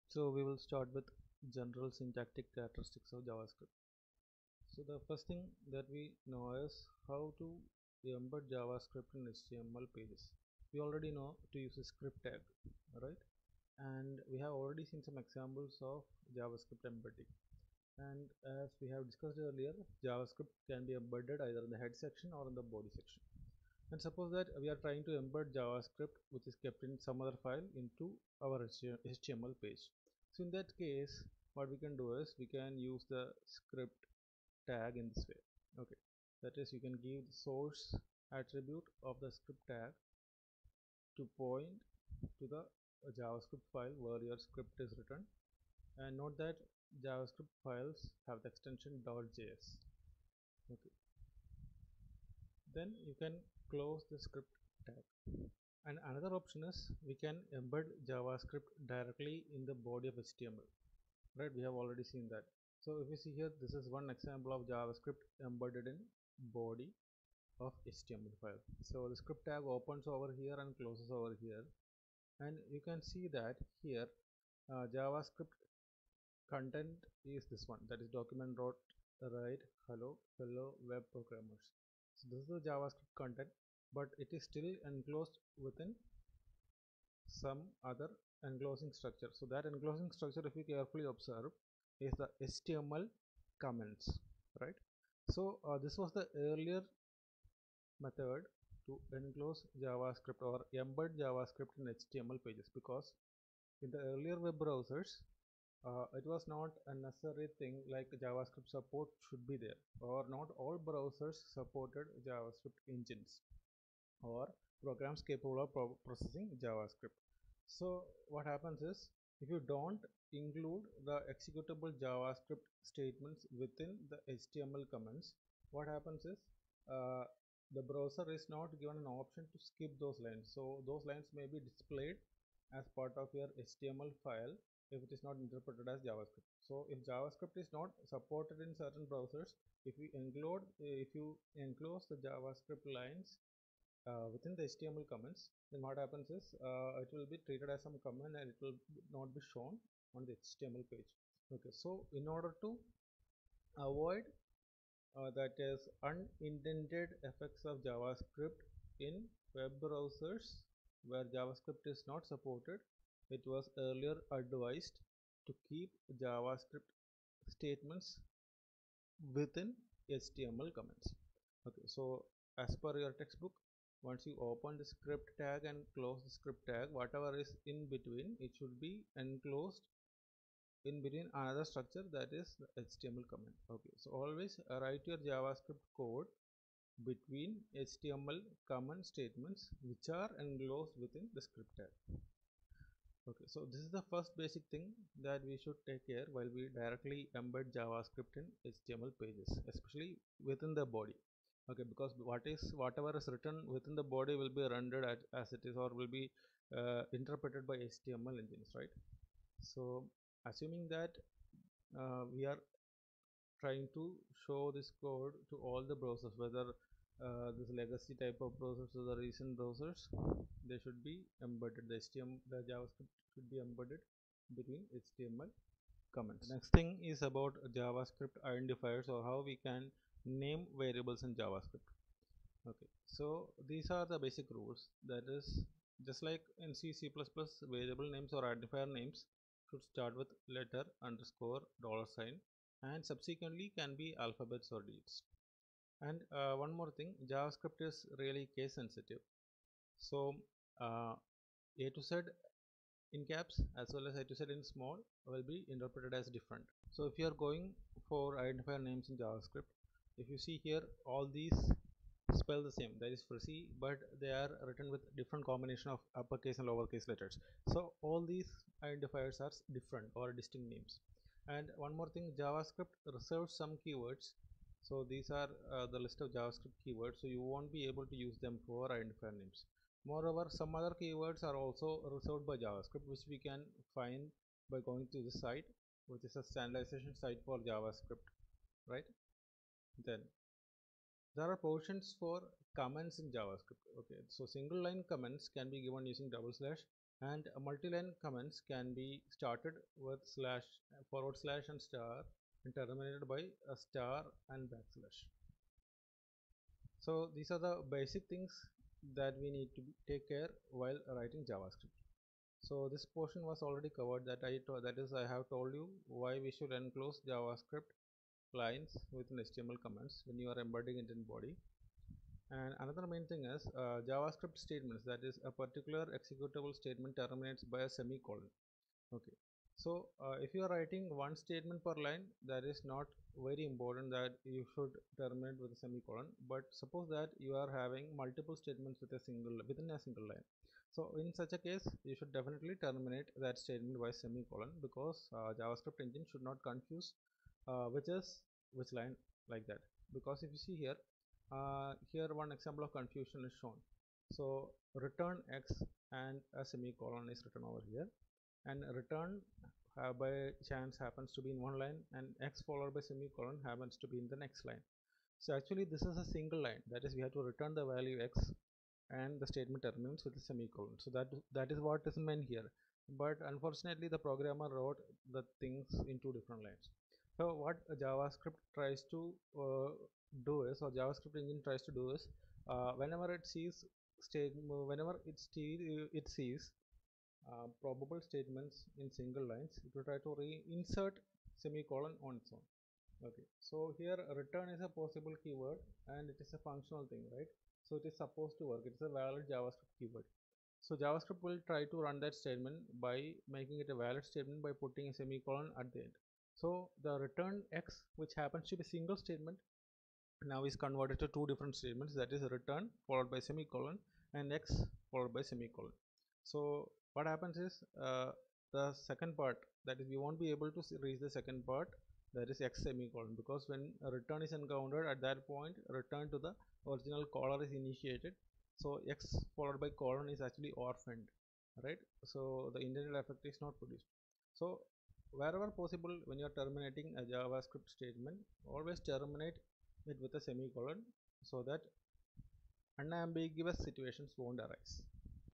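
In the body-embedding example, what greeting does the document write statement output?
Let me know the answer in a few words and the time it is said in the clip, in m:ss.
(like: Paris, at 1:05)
hello hello web programmers, at 1:19.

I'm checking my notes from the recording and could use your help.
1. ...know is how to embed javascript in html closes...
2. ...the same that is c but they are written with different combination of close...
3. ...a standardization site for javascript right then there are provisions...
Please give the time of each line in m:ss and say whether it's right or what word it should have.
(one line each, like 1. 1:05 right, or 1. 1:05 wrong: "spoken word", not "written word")
1. 0:06 wrong: "pages", not "closes"
2. 4:22 wrong: "uppercase", not "close"
3. 4:46 right.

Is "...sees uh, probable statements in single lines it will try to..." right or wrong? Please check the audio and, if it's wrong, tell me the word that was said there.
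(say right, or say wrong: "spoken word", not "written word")
right.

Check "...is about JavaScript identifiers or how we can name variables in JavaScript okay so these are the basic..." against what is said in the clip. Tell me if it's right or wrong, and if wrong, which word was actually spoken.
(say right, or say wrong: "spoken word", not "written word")
right.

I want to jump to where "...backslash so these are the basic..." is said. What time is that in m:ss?
5:04.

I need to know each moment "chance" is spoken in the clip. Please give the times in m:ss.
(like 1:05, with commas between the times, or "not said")
6:00.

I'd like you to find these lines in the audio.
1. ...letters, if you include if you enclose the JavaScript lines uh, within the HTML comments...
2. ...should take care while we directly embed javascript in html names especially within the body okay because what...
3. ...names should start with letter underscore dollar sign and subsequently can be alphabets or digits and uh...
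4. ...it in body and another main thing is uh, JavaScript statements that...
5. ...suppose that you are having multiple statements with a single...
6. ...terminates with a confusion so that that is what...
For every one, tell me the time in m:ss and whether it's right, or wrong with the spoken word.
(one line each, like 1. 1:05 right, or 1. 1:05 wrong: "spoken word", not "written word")
1. 2:19 wrong: "browsers", not "letters"
2. 3:15 wrong: "pages", not "names"
3. 3:58 right
4. 5:20 right
5. 5:36 right
6. 6:09 wrong: "semicolon", not "confusion".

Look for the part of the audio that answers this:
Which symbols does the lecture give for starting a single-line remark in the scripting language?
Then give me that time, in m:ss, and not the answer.
4:56.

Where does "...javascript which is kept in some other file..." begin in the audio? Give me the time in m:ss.
0:25.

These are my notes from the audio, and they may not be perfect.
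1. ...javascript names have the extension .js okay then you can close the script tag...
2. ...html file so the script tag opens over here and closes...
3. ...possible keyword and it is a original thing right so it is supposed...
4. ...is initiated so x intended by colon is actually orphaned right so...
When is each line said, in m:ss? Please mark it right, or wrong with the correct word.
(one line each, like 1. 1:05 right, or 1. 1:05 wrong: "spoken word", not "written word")
1. 0:47 wrong: "files", not "names"
2. 1:07 right
3. 6:34 wrong: "functional", not "original"
4. 7:07 wrong: "followed", not "intended".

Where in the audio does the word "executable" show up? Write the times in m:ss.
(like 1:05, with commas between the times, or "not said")
2:01, 5:26.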